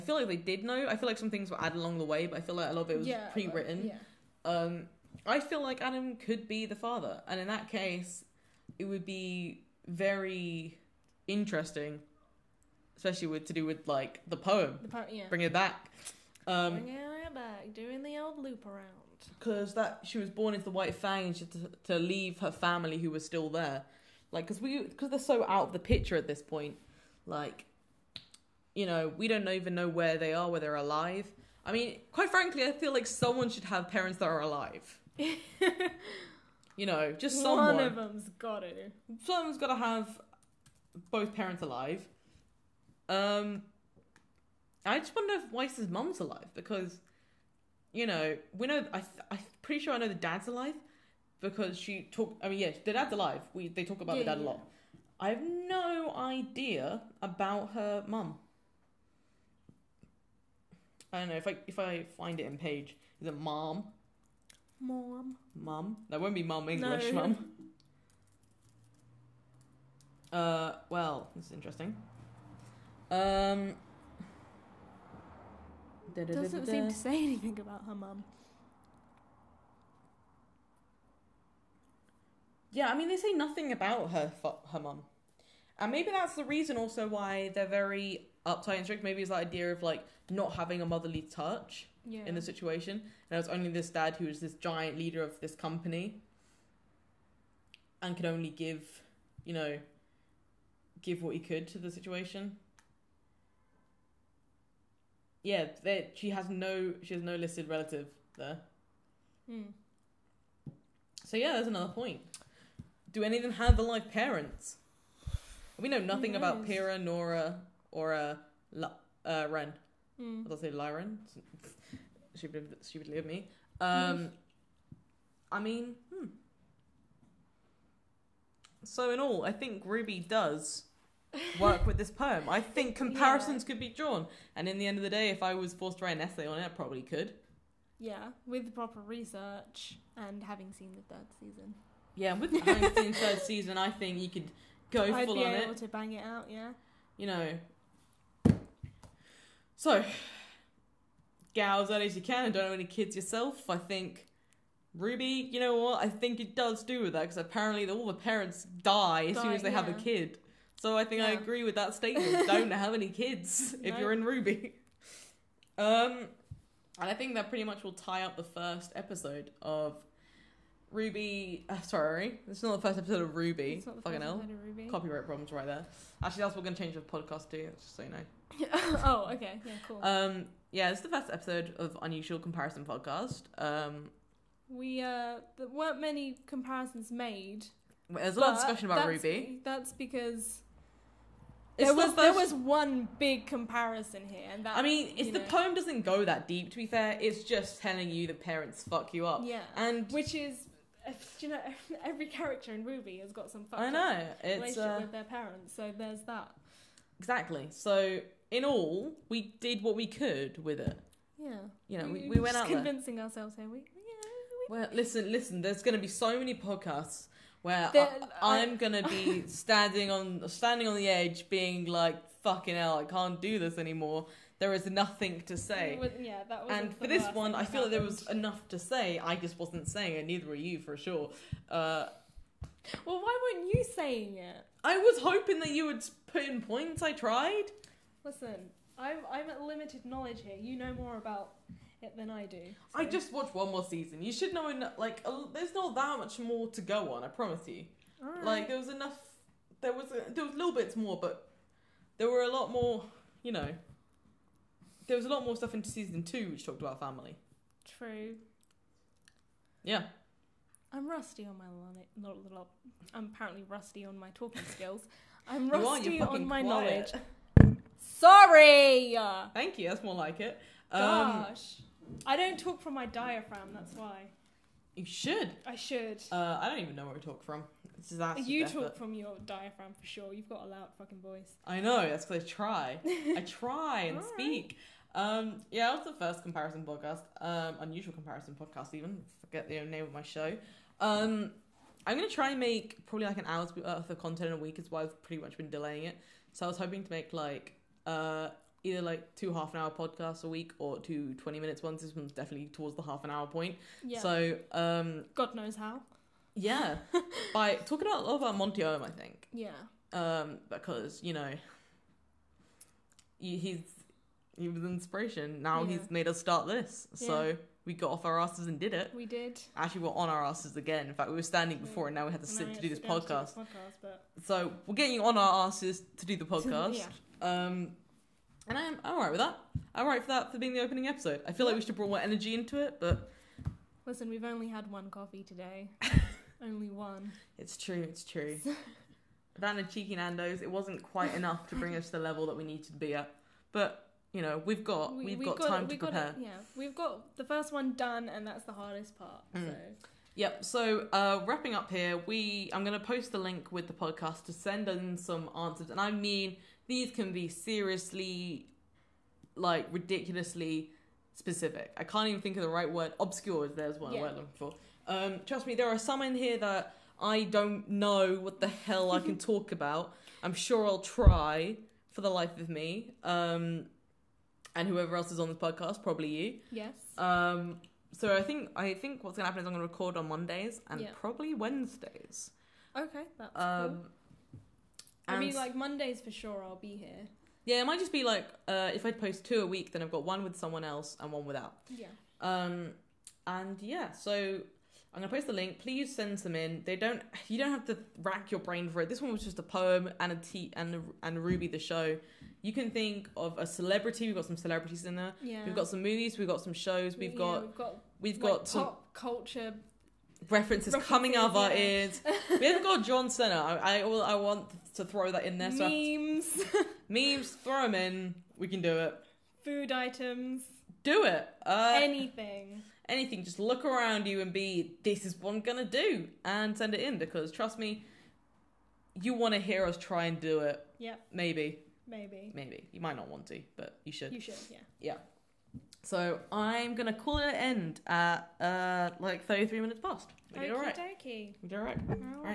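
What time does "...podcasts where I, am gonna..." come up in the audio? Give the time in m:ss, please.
3:36.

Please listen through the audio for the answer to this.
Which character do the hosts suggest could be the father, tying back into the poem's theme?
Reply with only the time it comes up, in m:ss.
0:05.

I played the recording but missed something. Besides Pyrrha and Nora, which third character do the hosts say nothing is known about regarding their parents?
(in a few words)
Lie Ren.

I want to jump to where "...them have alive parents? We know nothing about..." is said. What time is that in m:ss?
1:53.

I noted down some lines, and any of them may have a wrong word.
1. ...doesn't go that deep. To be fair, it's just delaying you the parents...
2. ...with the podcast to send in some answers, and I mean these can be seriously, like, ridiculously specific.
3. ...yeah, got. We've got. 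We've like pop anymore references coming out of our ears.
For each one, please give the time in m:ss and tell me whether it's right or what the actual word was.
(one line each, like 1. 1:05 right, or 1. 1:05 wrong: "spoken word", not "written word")
1. 3:15 wrong: "telling", not "delaying"
2. 5:53 right
3. 6:47 wrong: "culture", not "anymore".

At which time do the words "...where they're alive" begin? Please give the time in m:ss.
0:30.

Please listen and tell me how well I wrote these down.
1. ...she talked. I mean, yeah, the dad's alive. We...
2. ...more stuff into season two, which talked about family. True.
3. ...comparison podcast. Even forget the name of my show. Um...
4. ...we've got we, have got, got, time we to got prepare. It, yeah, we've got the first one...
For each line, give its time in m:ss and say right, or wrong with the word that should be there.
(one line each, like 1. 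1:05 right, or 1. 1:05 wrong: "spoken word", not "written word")
1. 0:51 right
2. 4:15 right
3. 4:48 right
4. 5:44 right.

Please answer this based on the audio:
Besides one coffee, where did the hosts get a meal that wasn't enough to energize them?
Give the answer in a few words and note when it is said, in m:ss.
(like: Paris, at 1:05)
Nando's, at 5:40.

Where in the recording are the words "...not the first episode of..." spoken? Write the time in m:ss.
2:52.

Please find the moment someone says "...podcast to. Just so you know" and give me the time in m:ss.
2:57.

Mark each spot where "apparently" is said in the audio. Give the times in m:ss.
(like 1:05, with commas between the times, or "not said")
2:37, 4:23.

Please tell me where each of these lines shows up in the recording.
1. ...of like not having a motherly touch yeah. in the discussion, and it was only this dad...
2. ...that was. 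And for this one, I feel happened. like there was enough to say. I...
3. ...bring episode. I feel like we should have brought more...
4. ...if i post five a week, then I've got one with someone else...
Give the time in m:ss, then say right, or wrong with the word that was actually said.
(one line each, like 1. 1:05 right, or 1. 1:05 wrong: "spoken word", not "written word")
1. 1:29 wrong: "situation", not "discussion"
2. 3:46 right
3. 5:30 wrong: "opening", not "bring"
4. 6:28 wrong: "two", not "five".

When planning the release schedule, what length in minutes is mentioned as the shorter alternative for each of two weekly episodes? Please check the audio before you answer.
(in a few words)
20.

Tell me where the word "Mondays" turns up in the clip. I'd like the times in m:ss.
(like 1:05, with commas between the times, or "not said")
6:20, 6:25.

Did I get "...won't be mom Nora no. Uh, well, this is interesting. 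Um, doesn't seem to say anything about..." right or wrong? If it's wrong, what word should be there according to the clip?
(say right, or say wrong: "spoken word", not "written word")
wrong: "English", not "Nora".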